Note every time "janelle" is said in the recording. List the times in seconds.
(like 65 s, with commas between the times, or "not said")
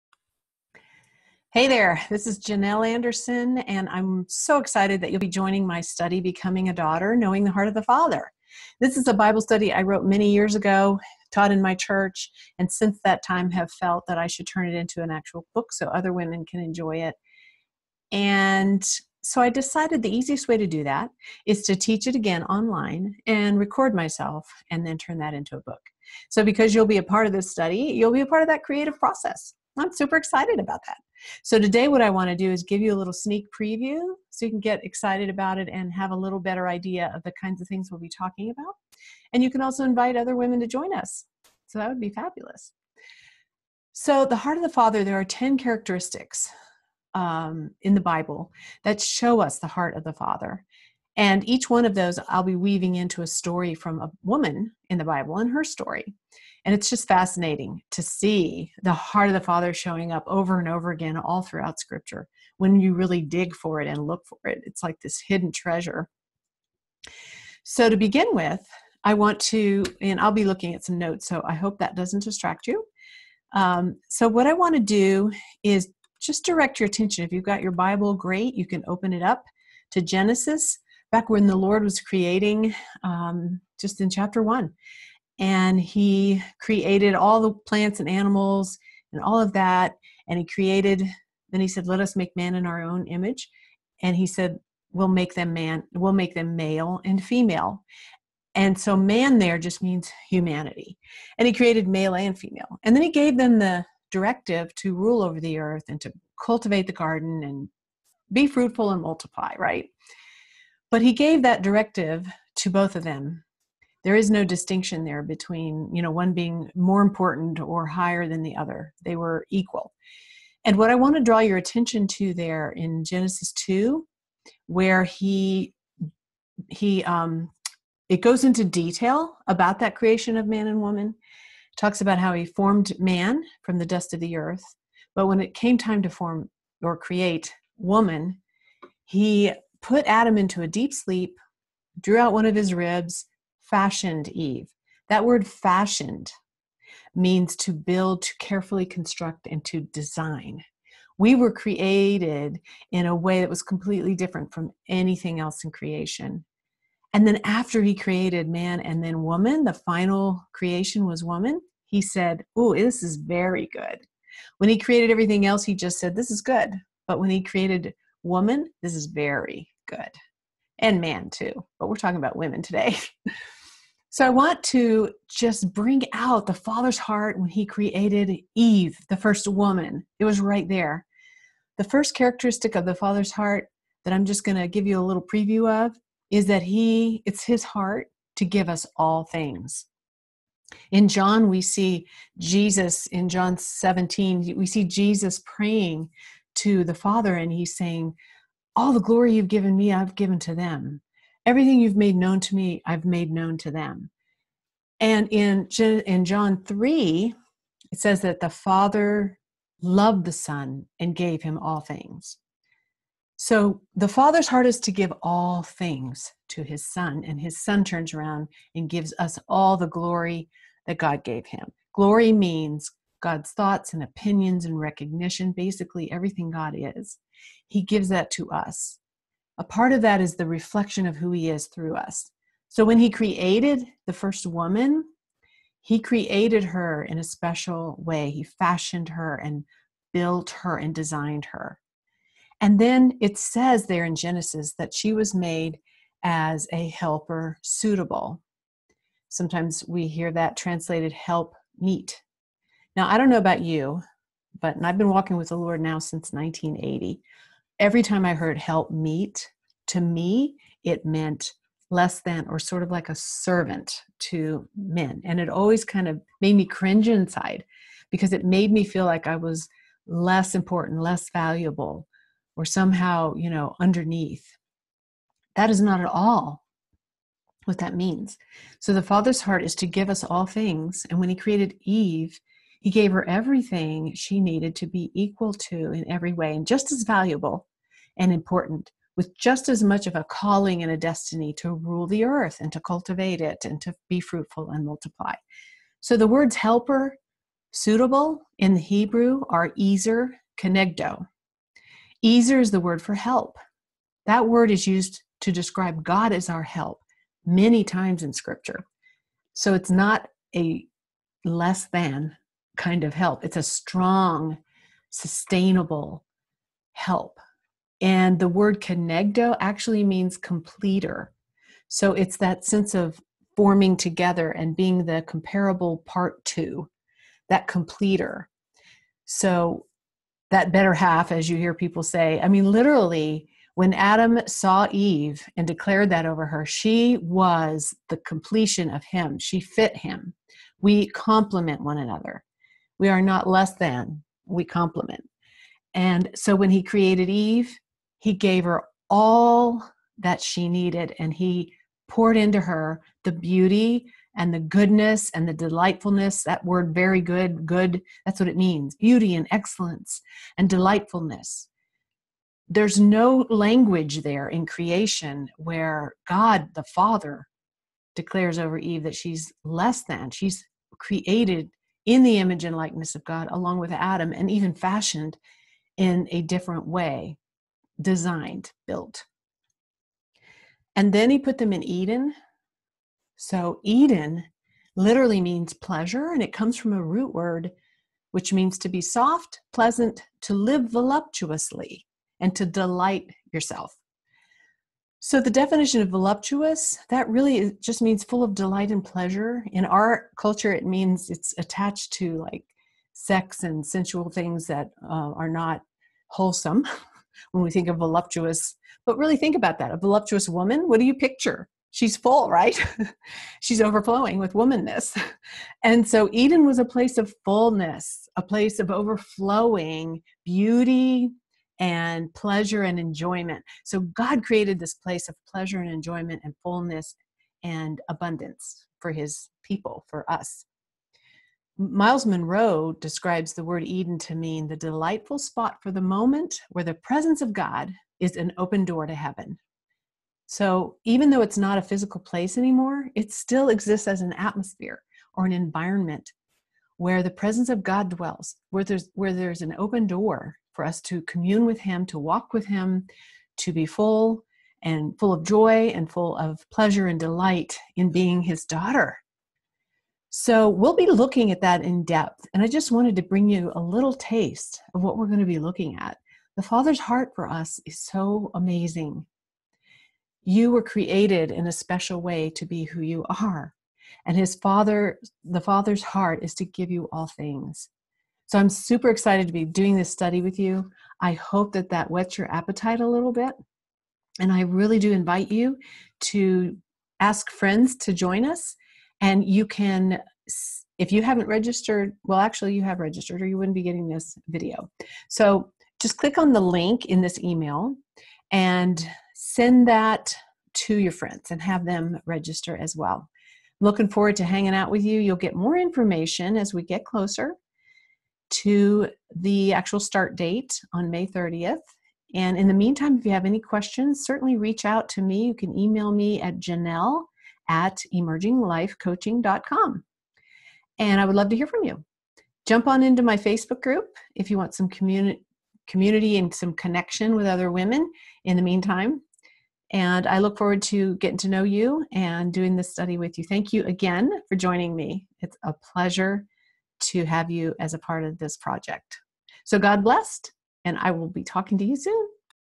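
2 s, 516 s.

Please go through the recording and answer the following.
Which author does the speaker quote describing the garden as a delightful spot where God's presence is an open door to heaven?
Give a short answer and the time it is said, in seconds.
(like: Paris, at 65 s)
Myles Munroe, at 431 s.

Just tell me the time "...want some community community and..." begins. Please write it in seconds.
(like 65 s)
524 s.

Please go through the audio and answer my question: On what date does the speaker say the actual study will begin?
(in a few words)
May 30th.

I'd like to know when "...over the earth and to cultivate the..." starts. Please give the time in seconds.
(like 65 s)
105 s.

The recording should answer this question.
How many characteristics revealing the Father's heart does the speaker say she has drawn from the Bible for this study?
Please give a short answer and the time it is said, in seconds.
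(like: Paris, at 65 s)
10, at 45 s.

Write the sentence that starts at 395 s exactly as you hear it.
So, the definition of voluptuous, that really just means full of delight and pleasure.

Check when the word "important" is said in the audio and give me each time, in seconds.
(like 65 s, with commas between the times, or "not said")
117 s, 270 s, 288 s.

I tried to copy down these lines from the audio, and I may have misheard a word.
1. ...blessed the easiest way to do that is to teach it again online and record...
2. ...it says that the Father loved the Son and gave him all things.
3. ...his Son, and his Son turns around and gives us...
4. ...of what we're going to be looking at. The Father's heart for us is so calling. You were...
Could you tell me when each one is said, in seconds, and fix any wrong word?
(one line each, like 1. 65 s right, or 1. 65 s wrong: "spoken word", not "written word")
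1. 19 s wrong: "decided", not "blessed"
2. 207 s right
3. 216 s right
4. 464 s wrong: "amazing", not "calling".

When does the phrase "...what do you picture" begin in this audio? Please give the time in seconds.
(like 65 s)
410 s.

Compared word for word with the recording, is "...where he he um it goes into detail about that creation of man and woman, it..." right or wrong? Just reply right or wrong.
right.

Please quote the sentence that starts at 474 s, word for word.
And his father, the father's heart is to give you all things.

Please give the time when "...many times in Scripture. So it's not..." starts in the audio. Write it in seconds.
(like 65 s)
307 s.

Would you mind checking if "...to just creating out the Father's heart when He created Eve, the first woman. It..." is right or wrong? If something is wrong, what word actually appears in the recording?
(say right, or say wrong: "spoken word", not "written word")
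wrong: "bring", not "creating".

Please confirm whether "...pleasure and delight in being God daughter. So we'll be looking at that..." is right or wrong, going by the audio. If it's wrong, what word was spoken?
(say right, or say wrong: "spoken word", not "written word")
wrong: "His", not "God".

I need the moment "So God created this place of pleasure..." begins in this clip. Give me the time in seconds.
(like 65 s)
423 s.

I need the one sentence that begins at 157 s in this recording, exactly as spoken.
And then after he created man and then woman, the final creation was woman, he said, Oh, this is very good.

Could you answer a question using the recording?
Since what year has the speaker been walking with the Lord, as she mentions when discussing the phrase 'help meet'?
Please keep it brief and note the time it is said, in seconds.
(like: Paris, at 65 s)
1980, at 256 s.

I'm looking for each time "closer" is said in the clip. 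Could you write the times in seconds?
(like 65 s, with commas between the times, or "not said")
507 s.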